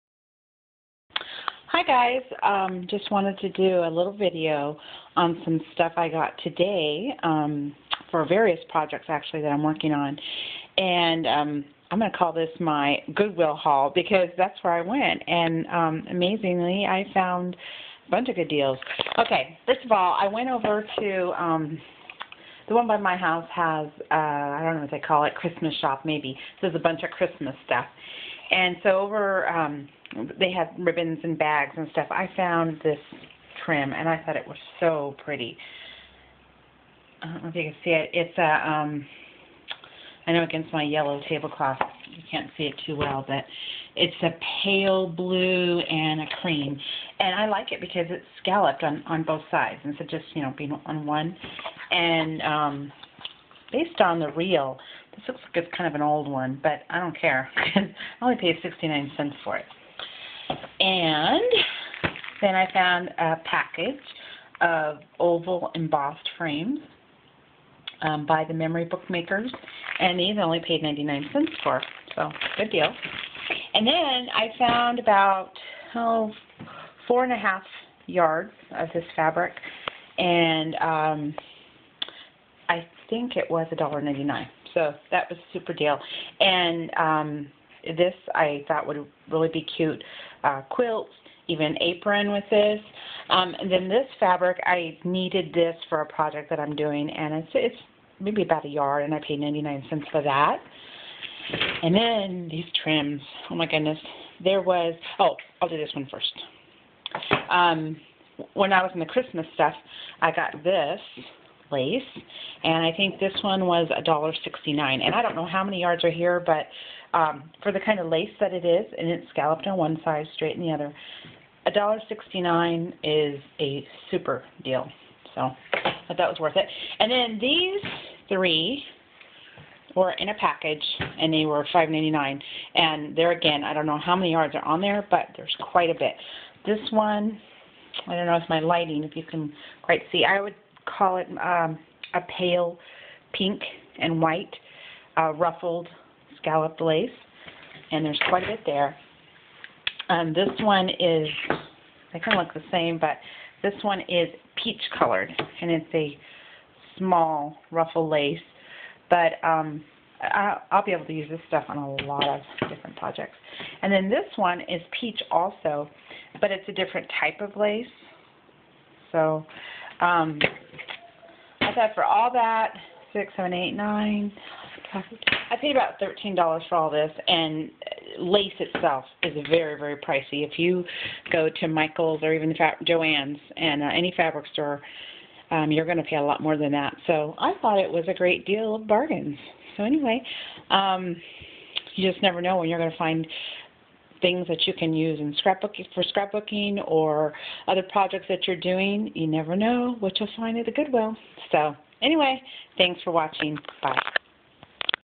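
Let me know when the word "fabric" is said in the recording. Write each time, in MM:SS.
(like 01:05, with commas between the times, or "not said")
01:19, 01:34, 03:04.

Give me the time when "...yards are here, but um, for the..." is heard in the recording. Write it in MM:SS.
01:55.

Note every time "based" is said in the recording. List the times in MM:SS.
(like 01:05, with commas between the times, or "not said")
00:53.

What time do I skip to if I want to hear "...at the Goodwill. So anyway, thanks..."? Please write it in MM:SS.
03:20.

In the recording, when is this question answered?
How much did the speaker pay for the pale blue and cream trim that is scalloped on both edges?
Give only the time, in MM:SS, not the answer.
00:58.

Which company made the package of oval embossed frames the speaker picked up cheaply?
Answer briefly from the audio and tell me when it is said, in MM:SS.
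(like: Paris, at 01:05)
Memory Bookmakers, at 01:08.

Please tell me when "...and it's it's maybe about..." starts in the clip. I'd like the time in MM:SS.
01:37.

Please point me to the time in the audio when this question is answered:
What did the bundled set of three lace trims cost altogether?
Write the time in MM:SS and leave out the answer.
02:11.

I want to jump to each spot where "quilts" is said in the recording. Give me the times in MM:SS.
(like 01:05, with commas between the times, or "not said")
01:30.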